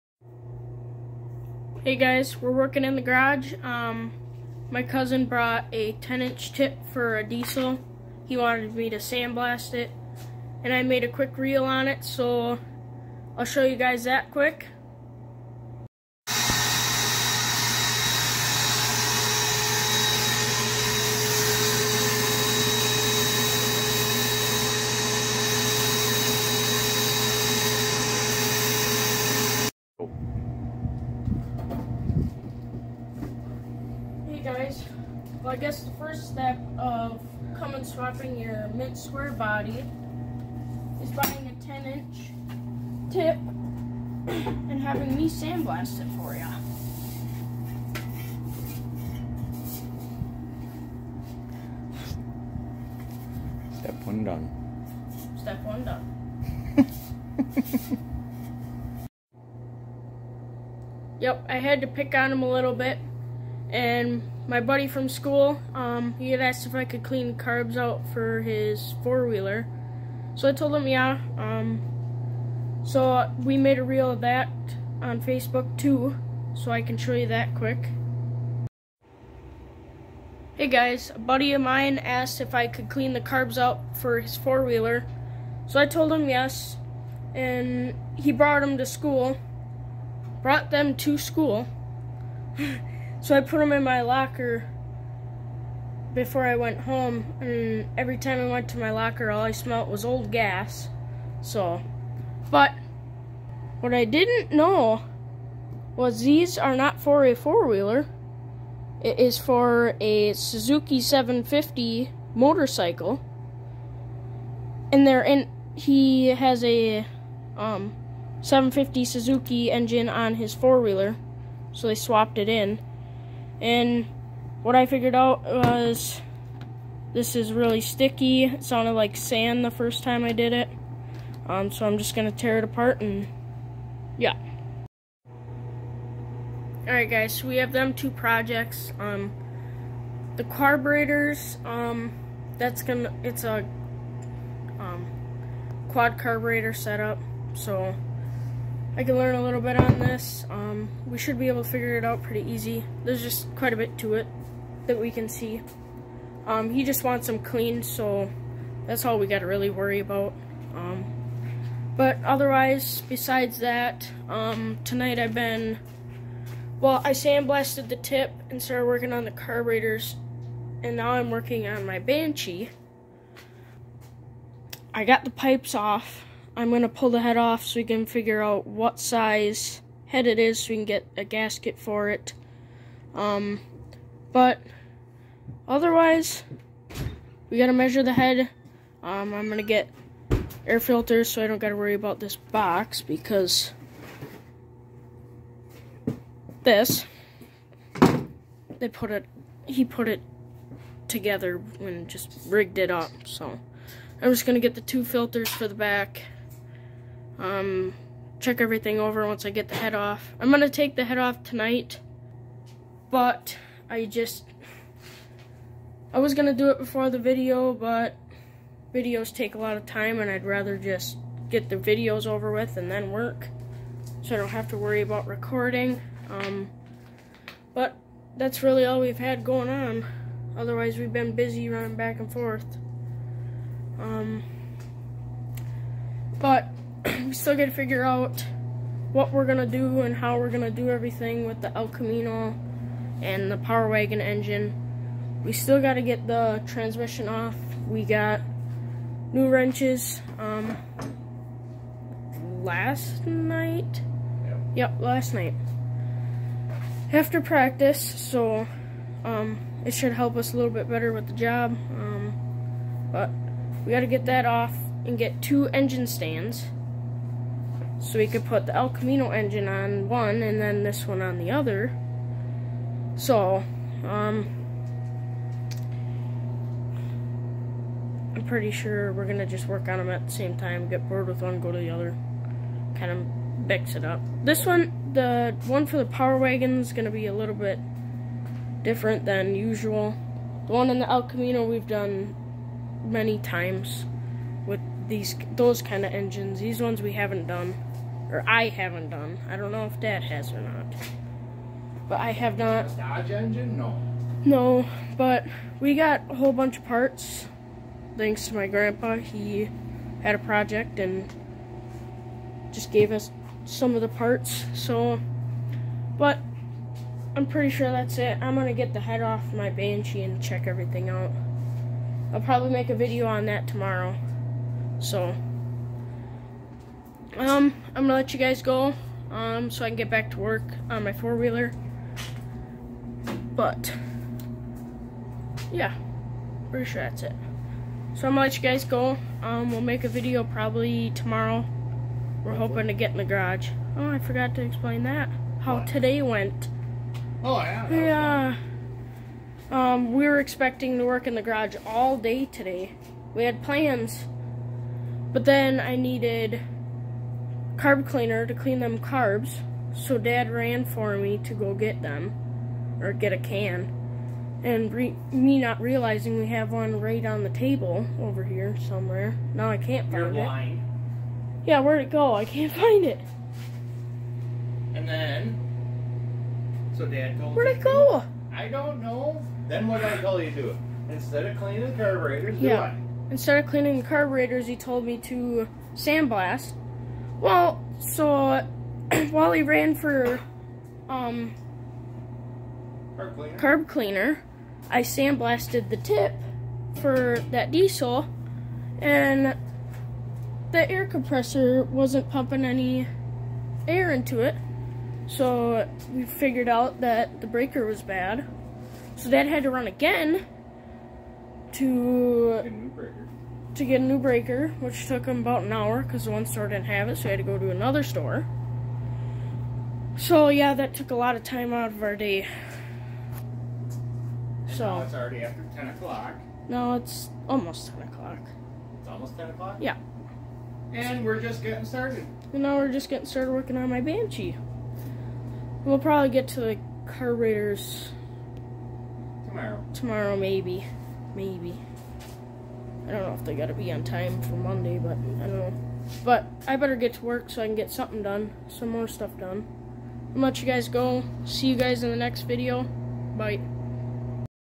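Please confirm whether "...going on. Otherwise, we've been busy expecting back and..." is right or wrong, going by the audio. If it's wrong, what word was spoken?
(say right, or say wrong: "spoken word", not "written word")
wrong: "running", not "expecting".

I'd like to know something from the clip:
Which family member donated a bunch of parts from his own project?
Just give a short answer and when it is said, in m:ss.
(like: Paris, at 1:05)
grandpa, at 5:08.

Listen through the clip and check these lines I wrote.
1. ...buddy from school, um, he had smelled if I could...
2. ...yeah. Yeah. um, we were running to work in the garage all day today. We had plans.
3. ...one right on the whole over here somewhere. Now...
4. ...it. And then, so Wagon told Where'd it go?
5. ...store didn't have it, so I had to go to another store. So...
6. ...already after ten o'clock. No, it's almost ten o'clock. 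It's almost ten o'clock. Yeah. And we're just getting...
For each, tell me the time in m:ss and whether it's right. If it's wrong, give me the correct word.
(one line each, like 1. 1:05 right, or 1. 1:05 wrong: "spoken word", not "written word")
1. 1:04 wrong: "asked", not "smelled"
2. 5:47 wrong: "expecting", not "running"
3. 6:06 wrong: "table", not "whole"
4. 6:13 wrong: "Dad", not "Wagon"
5. 6:56 right
6. 7:05 right.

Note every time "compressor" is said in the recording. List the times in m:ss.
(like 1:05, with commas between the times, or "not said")
6:41.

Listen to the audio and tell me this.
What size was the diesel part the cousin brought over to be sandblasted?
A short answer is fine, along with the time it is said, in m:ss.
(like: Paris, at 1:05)
10-inch, at 0:05.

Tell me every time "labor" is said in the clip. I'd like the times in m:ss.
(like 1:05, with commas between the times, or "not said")
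not said.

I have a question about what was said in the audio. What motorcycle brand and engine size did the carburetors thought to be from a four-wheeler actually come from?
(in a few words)
Suzuki 750.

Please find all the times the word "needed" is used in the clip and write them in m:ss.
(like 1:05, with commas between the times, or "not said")
5:55.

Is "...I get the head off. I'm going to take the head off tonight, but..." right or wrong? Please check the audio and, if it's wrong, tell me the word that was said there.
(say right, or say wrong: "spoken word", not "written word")
right.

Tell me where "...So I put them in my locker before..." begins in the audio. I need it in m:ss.
1:33.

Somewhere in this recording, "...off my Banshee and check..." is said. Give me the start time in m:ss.
5:19.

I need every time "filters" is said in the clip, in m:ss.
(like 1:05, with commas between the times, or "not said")
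3:10, 3:25.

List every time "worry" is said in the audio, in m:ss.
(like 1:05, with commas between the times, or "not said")
2:39, 3:11, 3:44.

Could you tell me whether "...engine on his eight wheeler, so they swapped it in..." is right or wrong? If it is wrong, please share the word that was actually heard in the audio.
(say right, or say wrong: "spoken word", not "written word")
wrong: "four", not "eight".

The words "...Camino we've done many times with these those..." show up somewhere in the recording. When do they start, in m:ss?
4:51.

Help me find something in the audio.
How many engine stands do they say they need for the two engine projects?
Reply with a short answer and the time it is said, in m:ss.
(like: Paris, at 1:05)
2, at 4:25.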